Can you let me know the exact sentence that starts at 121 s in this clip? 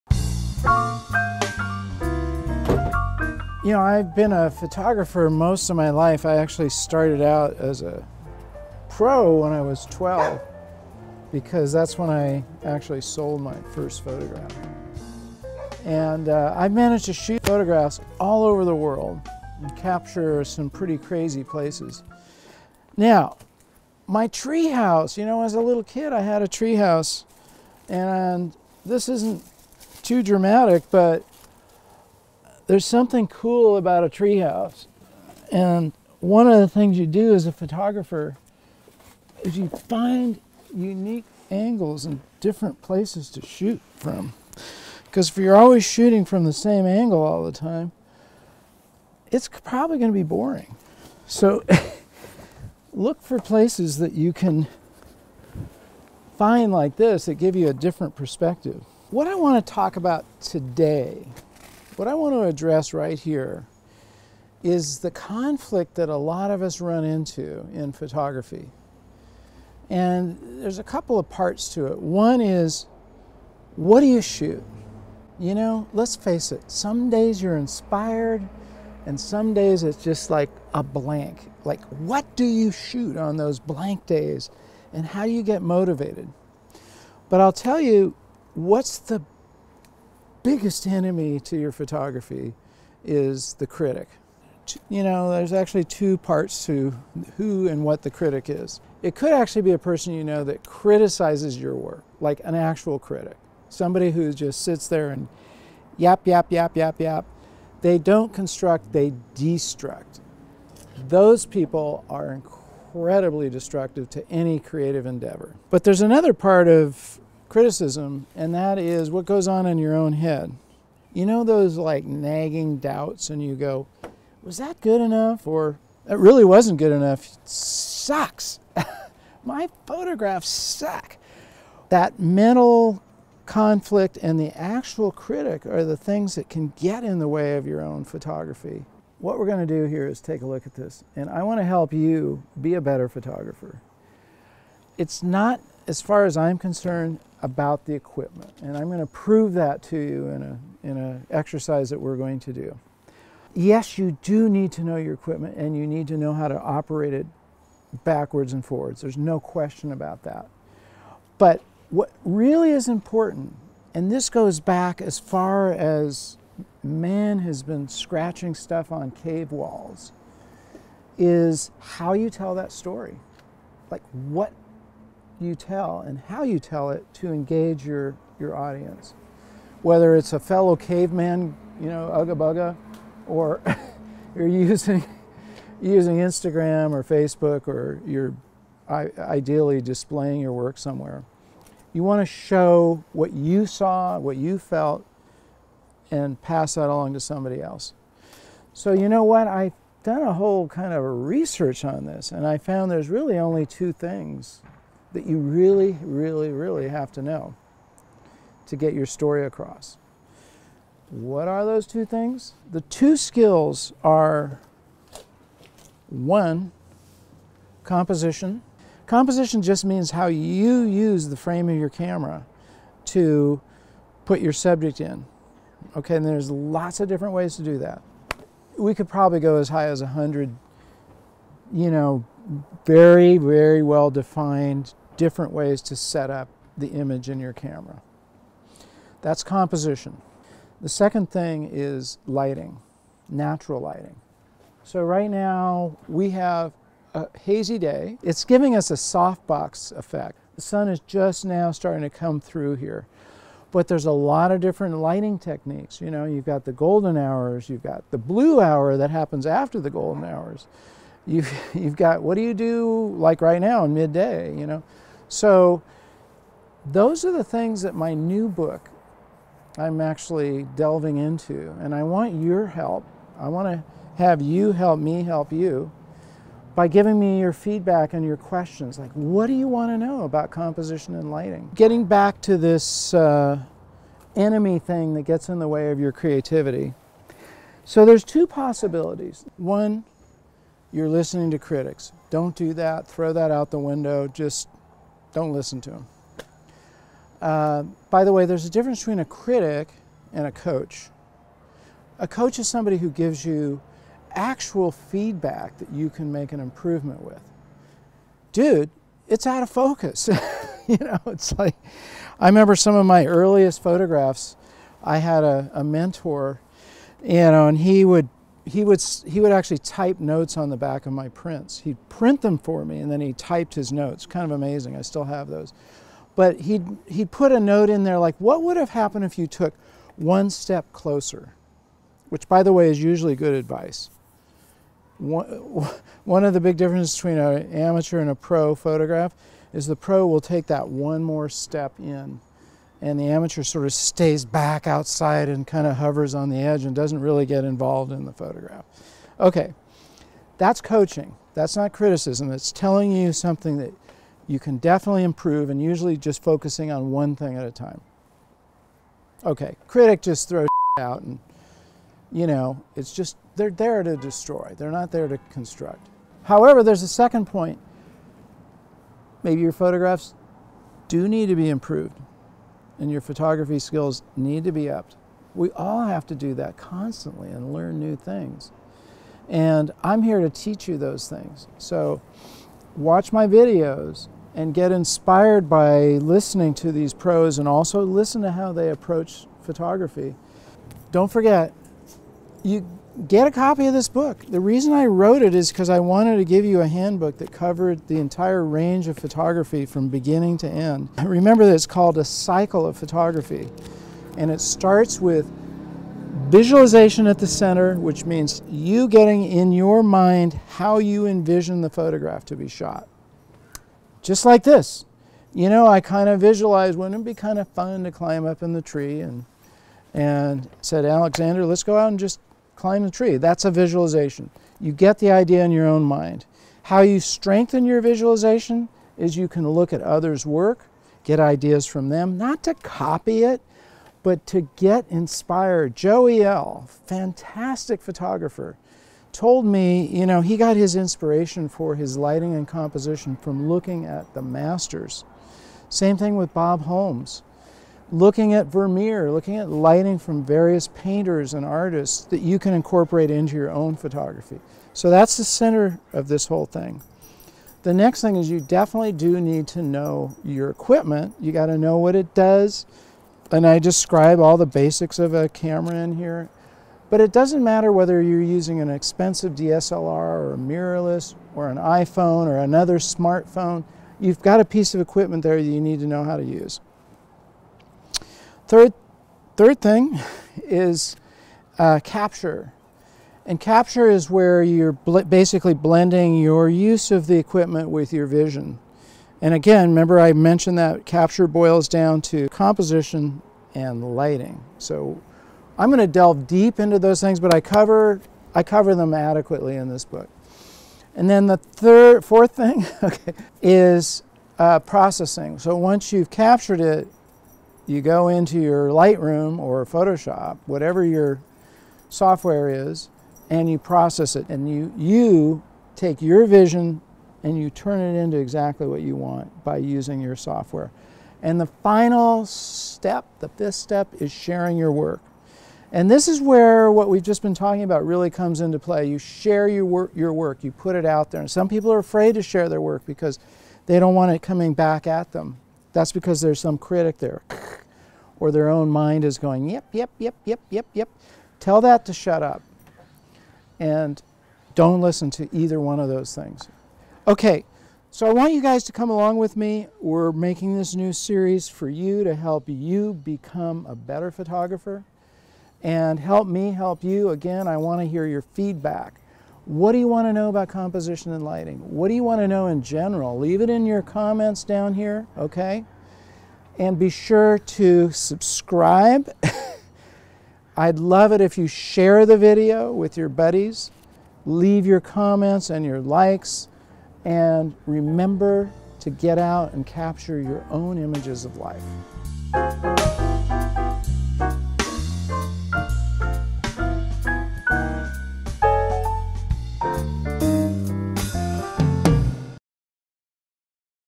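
You know those like nagging doubts, and you go, was that good enough?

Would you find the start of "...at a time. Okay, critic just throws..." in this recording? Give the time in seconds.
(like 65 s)
357 s.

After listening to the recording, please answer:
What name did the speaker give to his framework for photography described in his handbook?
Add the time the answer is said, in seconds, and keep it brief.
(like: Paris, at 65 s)
cycle of photography, at 402 s.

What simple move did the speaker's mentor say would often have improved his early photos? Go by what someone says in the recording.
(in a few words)
one step closer.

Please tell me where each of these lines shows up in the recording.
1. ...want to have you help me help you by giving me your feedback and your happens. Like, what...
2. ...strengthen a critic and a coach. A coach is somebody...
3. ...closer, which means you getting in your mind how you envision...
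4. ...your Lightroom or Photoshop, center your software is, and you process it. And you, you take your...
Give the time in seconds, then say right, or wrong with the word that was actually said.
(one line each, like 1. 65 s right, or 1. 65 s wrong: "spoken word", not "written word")
1. 273 s wrong: "questions", not "happens"
2. 298 s wrong: "between", not "strengthen"
3. 407 s wrong: "center", not "closer"
4. 508 s wrong: "whatever", not "center".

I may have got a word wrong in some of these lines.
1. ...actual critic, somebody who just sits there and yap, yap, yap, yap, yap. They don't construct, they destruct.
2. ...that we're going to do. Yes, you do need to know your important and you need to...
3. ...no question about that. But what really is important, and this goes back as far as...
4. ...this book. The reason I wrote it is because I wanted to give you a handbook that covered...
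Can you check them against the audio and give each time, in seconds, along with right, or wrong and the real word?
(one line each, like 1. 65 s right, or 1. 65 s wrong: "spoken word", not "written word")
1. 102 s right
2. 151 s wrong: "equipment", not "important"
3. 159 s right
4. 393 s right.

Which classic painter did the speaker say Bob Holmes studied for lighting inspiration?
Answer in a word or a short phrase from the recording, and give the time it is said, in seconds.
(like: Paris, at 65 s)
Vermeer, at 448 s.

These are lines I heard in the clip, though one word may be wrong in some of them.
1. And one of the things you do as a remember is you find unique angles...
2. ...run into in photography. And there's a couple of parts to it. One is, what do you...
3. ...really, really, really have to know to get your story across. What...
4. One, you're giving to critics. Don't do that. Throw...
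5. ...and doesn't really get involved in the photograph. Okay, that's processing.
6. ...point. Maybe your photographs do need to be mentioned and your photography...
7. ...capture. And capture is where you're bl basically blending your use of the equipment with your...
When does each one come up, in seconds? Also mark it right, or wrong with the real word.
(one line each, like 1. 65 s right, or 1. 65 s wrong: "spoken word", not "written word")
1. 35 s wrong: "photographer", not "remember"
2. 66 s right
3. 205 s right
4. 289 s wrong: "listening", not "giving"
5. 346 s wrong: "coaching", not "processing"
6. 367 s wrong: "improved", not "mentioned"
7. 482 s right.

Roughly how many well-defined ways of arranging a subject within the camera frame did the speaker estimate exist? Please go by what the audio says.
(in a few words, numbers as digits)
100.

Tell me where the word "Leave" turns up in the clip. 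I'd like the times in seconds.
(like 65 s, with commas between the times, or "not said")
563 s, 574 s.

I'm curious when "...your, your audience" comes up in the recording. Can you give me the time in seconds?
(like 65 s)
177 s.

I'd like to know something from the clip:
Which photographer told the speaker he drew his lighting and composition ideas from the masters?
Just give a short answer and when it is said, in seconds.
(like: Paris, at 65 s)
Joey L., at 435 s.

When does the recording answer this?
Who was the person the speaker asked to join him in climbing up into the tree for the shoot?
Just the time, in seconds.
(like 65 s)
421 s.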